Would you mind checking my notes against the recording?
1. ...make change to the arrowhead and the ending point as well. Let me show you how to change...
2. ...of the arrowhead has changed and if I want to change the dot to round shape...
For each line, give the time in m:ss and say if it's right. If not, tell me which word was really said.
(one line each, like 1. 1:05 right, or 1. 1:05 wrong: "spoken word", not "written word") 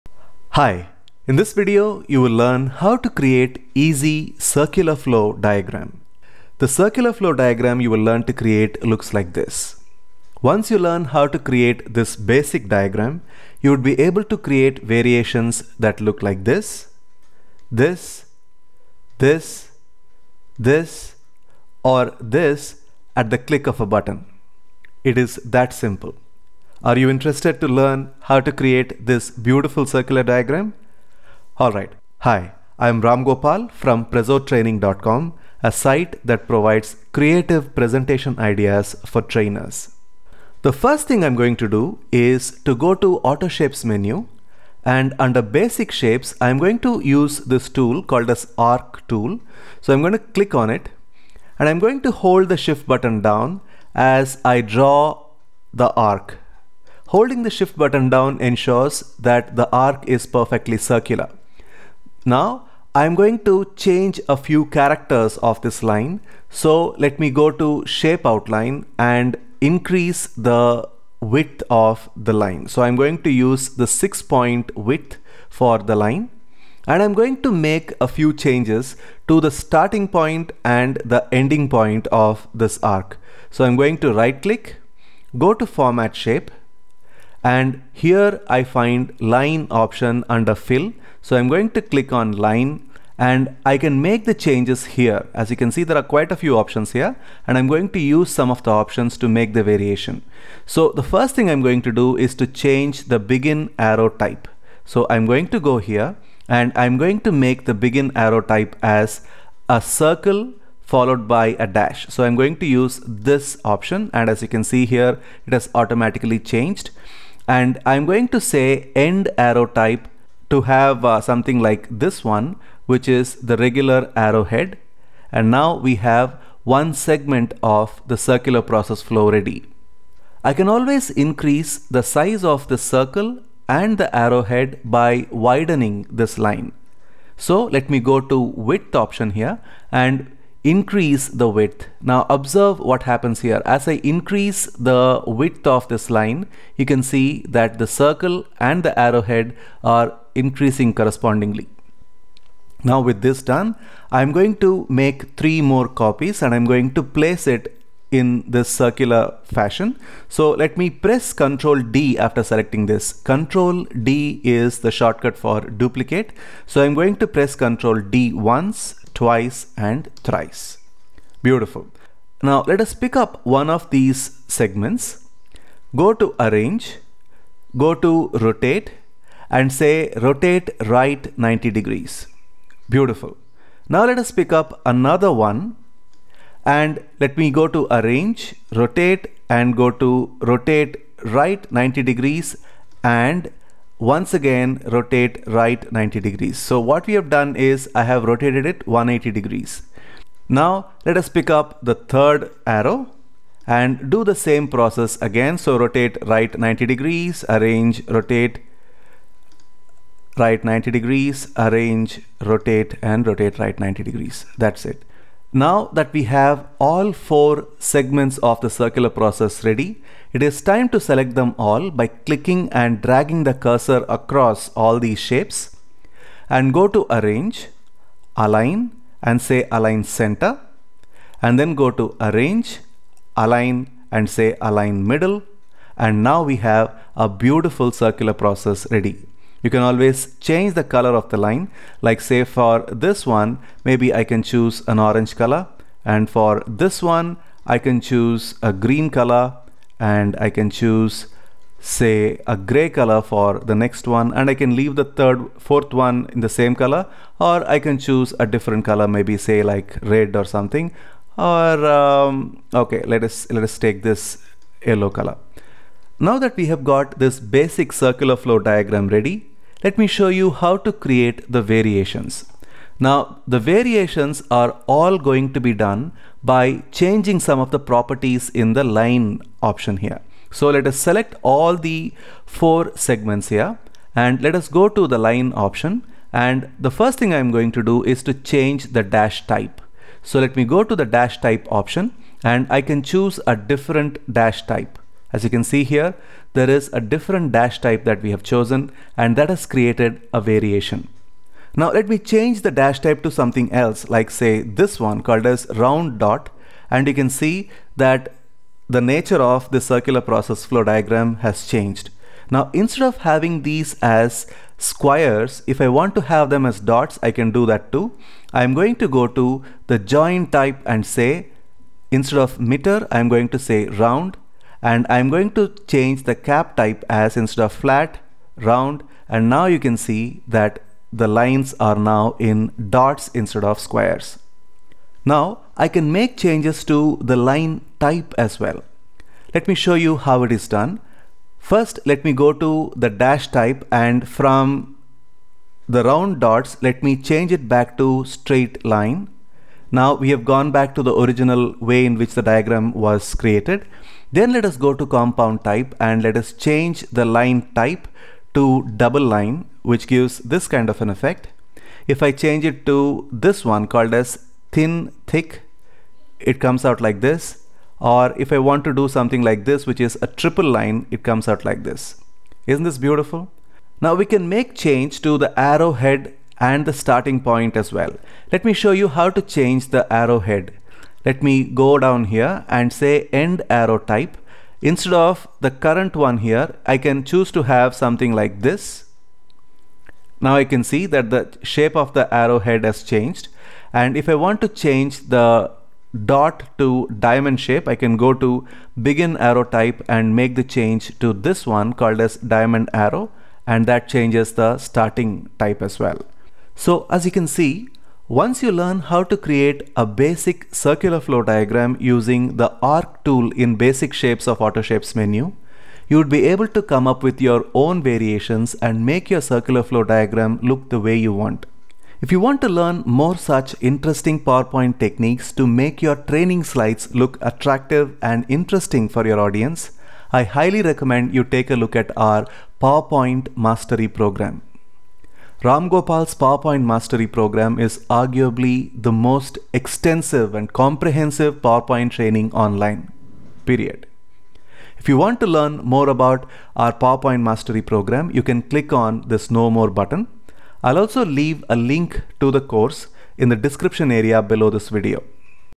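1. 6:14 wrong: "starting", not "ending"
2. 6:31 wrong: "diamond", not "round".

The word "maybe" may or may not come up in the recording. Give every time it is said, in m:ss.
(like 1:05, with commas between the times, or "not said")
4:03, 4:19.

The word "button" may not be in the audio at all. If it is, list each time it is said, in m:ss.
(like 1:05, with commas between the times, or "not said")
0:23, 0:52, 0:57, 7:29.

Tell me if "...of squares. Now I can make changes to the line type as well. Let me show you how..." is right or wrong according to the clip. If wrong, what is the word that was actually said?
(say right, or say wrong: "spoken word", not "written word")
right.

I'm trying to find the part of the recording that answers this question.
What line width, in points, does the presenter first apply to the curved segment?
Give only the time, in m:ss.
1:13.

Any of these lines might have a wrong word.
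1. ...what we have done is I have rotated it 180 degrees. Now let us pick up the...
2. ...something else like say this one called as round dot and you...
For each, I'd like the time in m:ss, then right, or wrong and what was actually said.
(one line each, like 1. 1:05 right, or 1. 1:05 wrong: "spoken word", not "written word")
1. 3:16 right
2. 5:03 right.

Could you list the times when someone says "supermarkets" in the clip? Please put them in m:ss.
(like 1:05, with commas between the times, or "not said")
not said.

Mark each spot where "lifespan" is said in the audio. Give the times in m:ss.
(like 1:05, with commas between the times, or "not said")
not said.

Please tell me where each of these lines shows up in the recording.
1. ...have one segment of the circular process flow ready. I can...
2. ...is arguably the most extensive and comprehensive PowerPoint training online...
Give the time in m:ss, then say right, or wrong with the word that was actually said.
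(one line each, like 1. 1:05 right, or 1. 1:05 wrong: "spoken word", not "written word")
1. 2:05 right
2. 7:17 right.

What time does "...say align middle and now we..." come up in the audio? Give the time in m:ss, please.
3:54.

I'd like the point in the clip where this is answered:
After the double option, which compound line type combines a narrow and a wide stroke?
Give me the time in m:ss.
6:04.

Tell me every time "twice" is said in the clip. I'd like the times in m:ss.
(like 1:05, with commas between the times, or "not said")
2:49.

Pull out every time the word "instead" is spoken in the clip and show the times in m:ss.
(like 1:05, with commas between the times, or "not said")
5:12, 5:22, 5:27, 5:33, 6:24.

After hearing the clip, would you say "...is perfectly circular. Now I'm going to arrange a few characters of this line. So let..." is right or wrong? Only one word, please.
wrong.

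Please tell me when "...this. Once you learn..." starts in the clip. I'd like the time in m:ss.
0:09.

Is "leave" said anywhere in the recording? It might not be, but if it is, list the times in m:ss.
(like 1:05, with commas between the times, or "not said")
4:14, 7:31.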